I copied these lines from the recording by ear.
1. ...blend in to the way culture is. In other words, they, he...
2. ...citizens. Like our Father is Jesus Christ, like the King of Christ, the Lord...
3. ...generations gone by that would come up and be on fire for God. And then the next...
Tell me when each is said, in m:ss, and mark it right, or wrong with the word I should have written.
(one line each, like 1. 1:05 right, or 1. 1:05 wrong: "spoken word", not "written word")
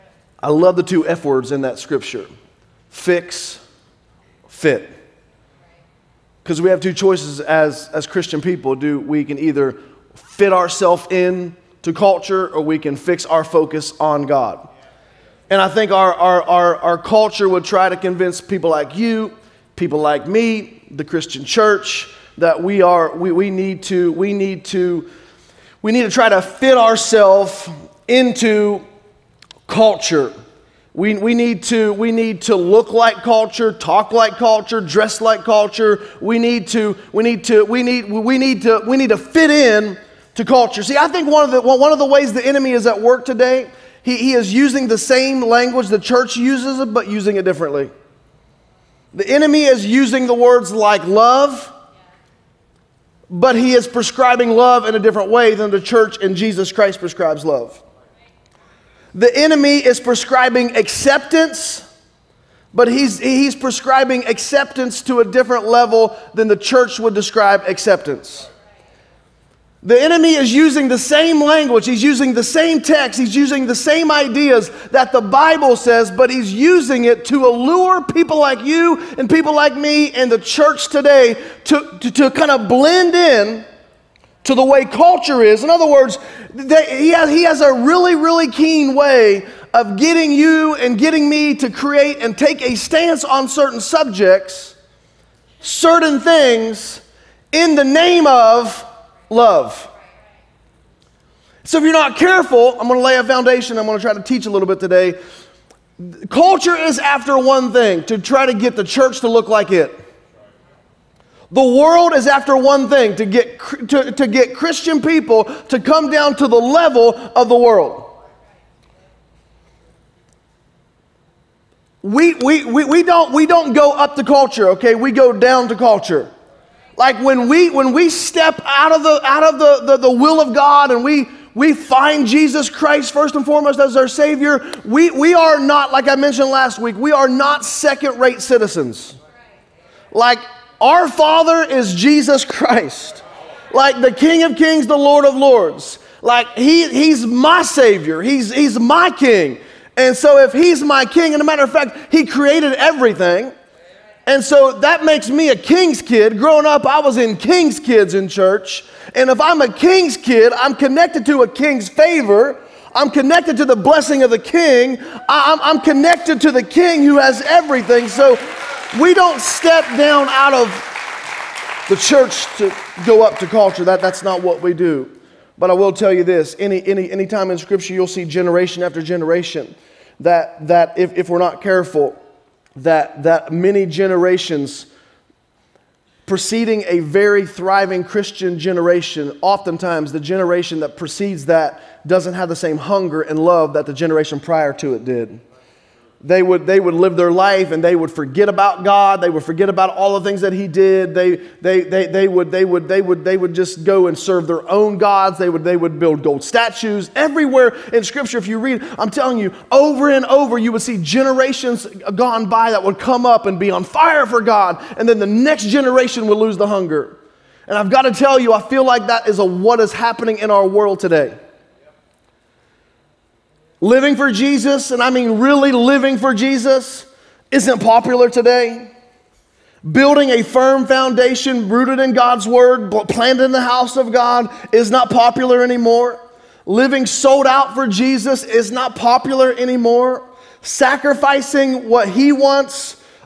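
1. 1:22 right
2. 2:18 wrong: "Kings", not "Christ"
3. 3:30 right.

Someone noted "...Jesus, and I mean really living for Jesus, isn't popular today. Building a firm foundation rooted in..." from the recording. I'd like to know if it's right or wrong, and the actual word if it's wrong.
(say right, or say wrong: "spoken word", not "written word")
right.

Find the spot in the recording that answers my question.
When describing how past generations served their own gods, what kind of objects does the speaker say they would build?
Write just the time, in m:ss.
3:26.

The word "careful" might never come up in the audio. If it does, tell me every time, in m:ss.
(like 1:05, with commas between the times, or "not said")
1:42, 3:01.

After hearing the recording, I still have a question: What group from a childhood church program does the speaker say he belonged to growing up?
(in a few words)
King's Kids.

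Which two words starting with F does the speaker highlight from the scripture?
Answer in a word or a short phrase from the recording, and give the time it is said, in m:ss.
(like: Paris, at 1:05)
fix, fit, at 0:02.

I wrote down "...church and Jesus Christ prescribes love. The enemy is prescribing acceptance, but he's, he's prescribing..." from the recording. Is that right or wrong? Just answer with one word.
right.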